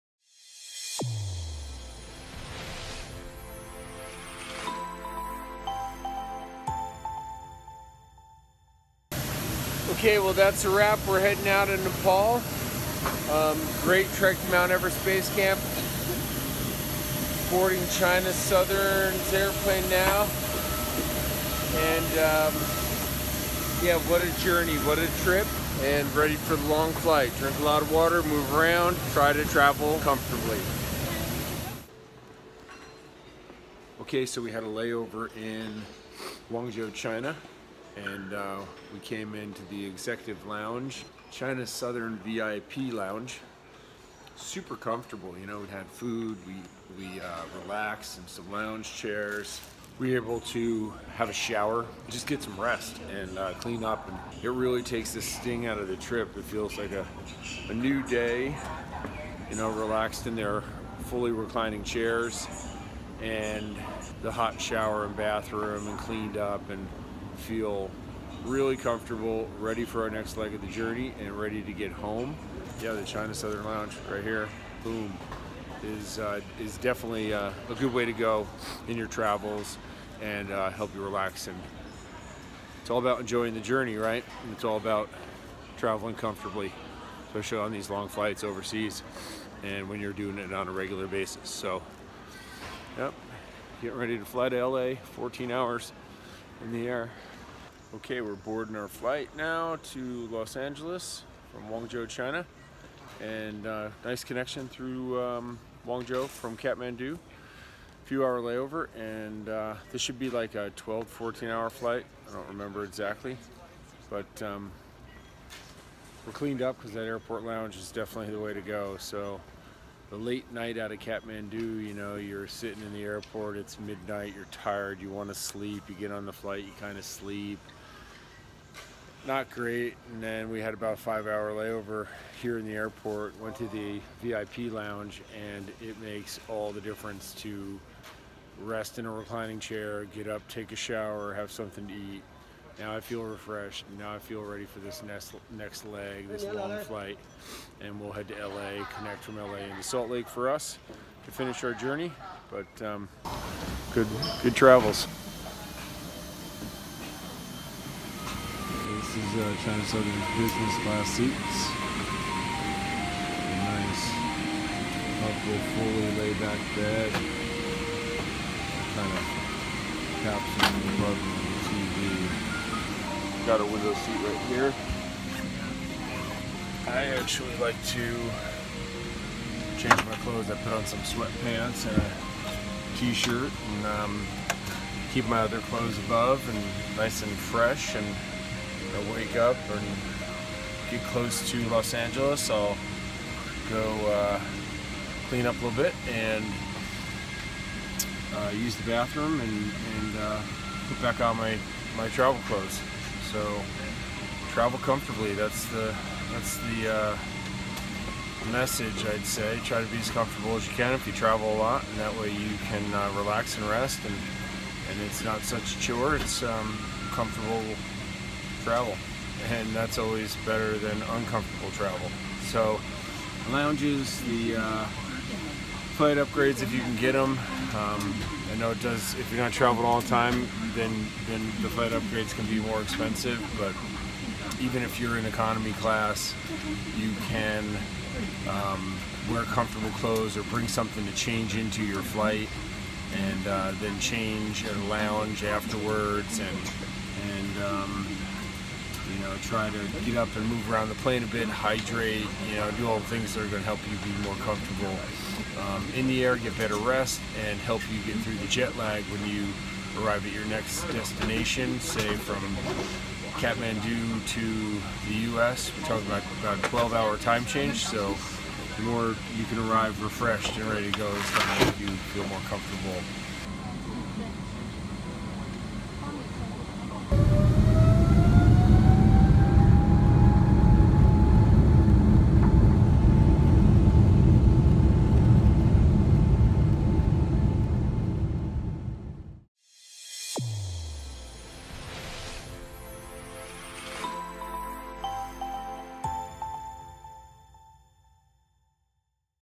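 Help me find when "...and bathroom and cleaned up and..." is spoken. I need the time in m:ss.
1:05.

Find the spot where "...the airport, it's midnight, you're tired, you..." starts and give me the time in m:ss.
2:02.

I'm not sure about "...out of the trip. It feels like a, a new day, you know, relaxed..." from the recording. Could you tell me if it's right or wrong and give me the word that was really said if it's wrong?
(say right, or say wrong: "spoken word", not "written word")
right.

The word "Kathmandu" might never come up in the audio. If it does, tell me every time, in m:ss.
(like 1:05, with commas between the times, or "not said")
1:46, 2:00, 4:23.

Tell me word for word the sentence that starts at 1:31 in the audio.
So, yep, getting ready to fly to LA, 14 hours in the air.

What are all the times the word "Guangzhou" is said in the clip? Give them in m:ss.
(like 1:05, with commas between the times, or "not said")
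0:36, 1:41, 1:45.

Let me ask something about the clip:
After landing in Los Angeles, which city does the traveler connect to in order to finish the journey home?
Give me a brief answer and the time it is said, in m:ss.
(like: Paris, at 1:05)
Salt Lake, at 2:29.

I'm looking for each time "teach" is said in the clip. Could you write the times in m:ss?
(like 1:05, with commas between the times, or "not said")
not said.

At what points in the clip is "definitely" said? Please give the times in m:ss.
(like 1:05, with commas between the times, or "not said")
1:16, 1:57.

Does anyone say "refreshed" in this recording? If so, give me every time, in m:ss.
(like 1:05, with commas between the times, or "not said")
2:23, 4:30.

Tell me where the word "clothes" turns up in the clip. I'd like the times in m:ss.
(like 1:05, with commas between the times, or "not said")
3:00, 3:05, 3:22, 3:59.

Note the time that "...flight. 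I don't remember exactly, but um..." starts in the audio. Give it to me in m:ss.
1:51.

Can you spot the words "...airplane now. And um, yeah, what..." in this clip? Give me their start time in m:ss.
0:19.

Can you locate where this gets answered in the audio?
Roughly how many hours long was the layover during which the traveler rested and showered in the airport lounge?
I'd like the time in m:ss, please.
2:10.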